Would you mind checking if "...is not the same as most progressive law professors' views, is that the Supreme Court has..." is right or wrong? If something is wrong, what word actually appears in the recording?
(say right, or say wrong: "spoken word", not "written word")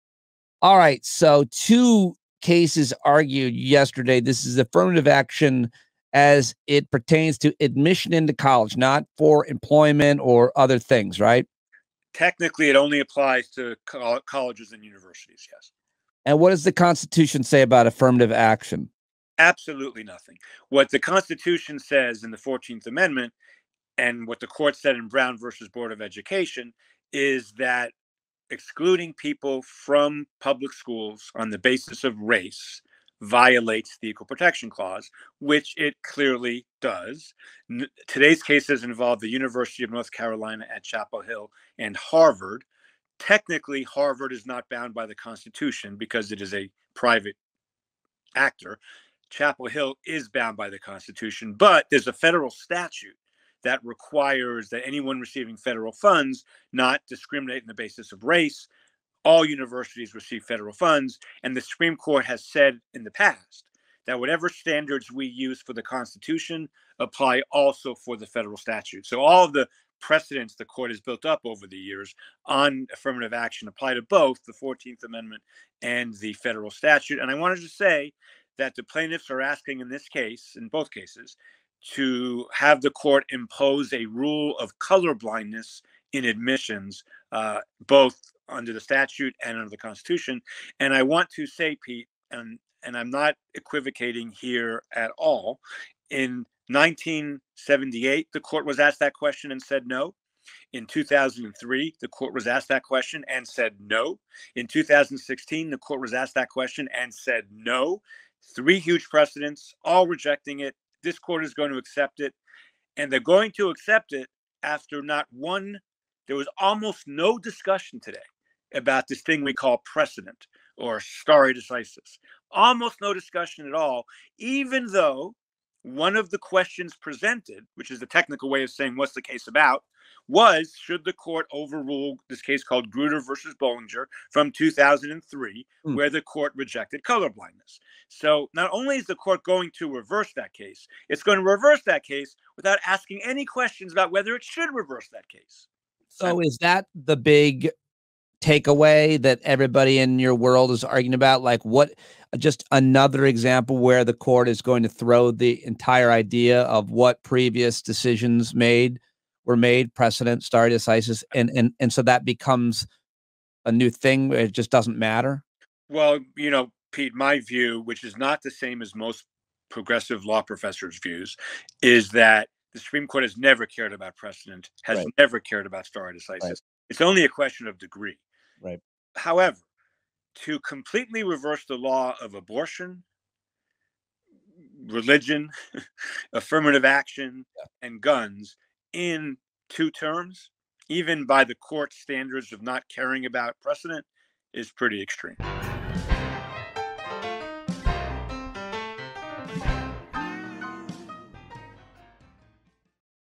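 right.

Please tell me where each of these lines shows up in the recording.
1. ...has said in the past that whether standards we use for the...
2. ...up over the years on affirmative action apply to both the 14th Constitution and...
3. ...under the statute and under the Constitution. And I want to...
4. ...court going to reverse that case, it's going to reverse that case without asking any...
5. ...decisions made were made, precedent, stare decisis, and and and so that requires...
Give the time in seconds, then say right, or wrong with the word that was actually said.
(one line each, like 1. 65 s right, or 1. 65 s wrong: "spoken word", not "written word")
1. 62 s wrong: "whatever", not "whether"
2. 71 s wrong: "Amendment", not "Constitution"
3. 88 s right
4. 139 s right
5. 157 s wrong: "becomes", not "requires".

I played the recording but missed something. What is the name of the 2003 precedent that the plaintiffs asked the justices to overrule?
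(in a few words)
Grutter versus Bollinger.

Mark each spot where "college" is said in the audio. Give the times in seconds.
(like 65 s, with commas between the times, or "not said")
8 s, 14 s.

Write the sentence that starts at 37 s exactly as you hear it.
N- today's cases involve the University of North Carolina at Chapel Hill and Harvard.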